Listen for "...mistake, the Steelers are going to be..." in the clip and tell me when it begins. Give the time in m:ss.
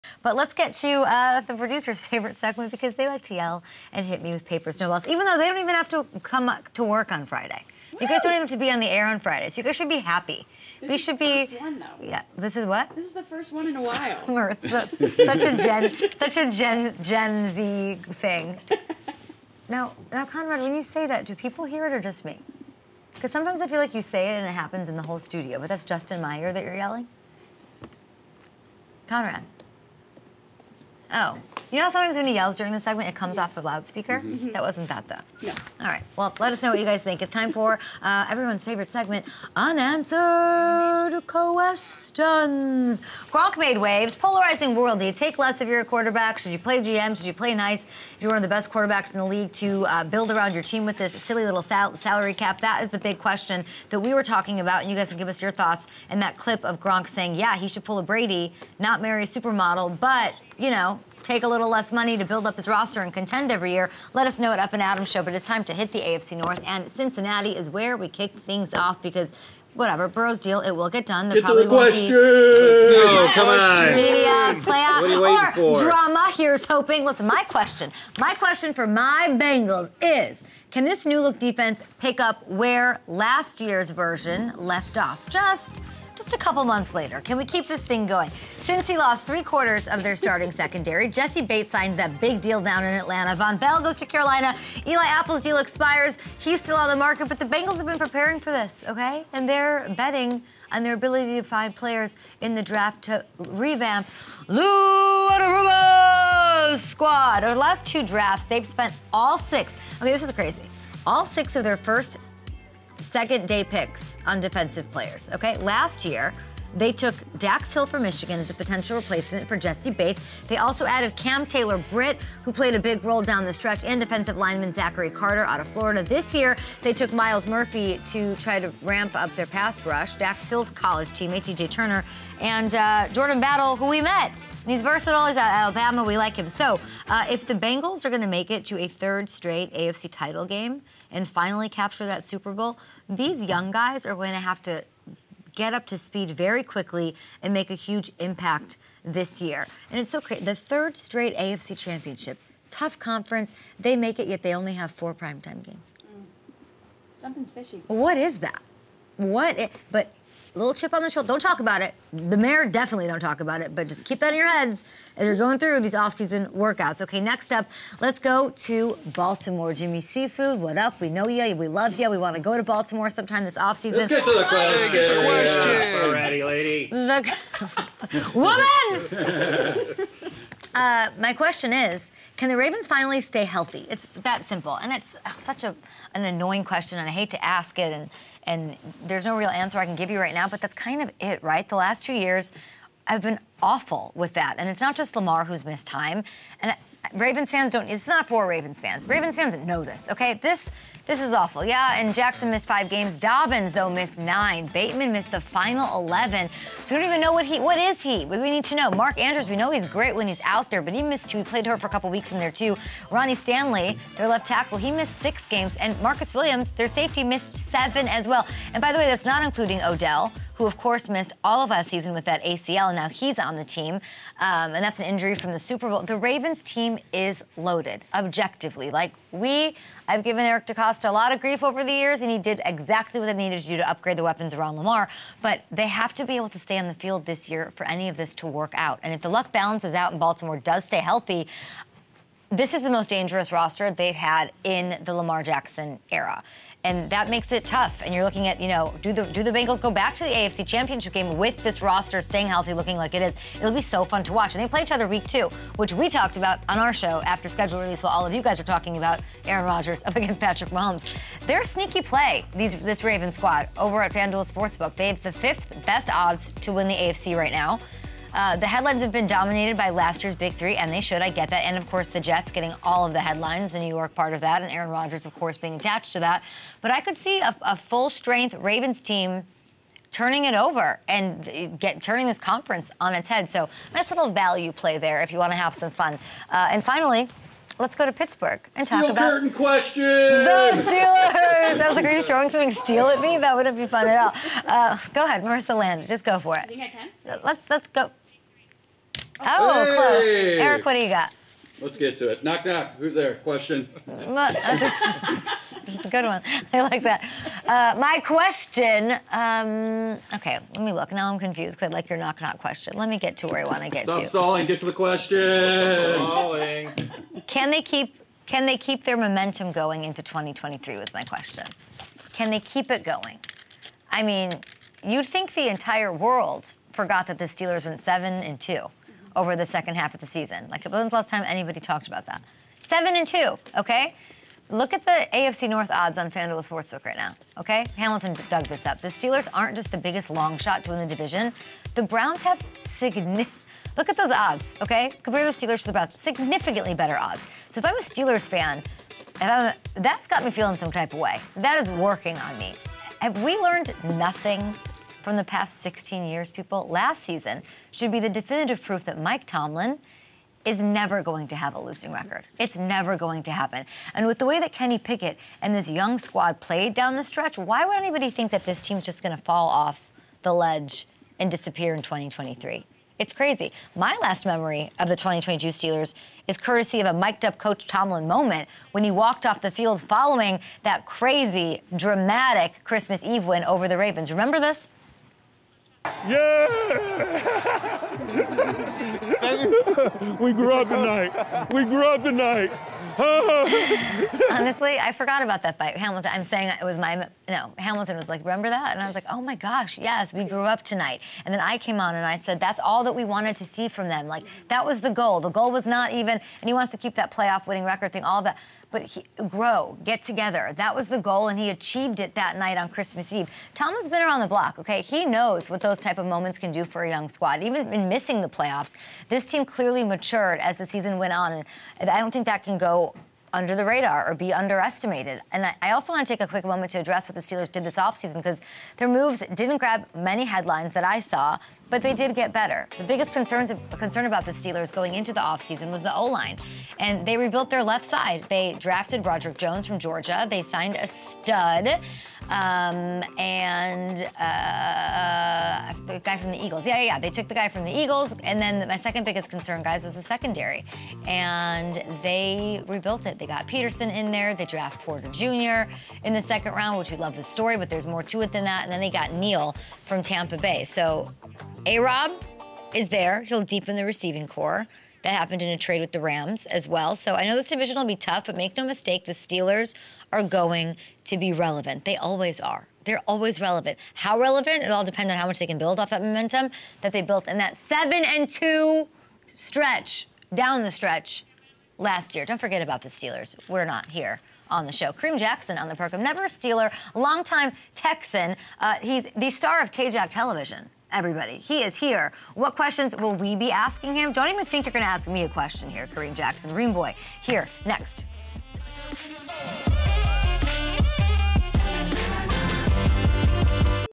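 7:48.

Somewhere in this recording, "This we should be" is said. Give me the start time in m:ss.
0:10.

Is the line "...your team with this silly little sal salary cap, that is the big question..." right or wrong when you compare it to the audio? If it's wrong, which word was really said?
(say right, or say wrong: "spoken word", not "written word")
right.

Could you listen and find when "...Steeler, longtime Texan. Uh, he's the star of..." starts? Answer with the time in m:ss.
8:06.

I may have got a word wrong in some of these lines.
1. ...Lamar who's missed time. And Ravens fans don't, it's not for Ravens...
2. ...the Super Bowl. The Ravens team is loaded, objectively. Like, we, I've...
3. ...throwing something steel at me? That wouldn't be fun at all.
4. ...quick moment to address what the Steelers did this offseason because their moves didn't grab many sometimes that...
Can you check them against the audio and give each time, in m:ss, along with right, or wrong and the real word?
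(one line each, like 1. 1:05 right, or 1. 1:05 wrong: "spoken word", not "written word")
1. 3:15 right
2. 3:45 right
3. 4:52 right
4. 7:06 wrong: "headlines", not "sometimes".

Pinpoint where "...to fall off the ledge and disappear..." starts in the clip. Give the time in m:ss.
6:09.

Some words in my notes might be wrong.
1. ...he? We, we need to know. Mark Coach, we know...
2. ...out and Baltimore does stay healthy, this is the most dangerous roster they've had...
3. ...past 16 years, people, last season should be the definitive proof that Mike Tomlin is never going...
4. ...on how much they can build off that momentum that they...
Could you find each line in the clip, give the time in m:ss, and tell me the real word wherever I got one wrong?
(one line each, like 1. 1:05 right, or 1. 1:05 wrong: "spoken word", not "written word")
1. 3:27 wrong: "Andrews", not "Coach"
2. 3:59 right
3. 5:55 right
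4. 7:55 right.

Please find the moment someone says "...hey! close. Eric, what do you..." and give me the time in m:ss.
4:59.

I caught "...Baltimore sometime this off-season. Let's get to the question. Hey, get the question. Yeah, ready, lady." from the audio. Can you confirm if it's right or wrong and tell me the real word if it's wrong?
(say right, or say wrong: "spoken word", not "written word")
right.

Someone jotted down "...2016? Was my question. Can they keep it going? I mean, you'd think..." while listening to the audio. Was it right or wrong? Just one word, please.
wrong.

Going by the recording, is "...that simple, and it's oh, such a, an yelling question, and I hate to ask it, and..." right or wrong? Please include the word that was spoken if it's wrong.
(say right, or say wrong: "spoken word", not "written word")
wrong: "annoying", not "yelling".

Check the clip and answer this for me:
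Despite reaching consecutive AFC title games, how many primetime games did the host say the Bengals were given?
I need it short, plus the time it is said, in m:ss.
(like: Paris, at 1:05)
4, at 2:34.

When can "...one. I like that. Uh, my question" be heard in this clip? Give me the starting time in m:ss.
5:06.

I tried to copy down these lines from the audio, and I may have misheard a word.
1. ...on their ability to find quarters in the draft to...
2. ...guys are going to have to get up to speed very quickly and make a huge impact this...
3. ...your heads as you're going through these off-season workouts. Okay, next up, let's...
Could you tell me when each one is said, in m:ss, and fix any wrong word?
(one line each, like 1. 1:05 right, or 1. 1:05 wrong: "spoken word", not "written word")
1. 1:40 wrong: "players", not "quarters"
2. 2:23 right
3. 2:44 right.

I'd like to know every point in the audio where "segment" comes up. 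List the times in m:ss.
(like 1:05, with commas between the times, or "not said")
0:02, 0:32, 0:38.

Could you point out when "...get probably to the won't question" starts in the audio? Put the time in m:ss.
1:11.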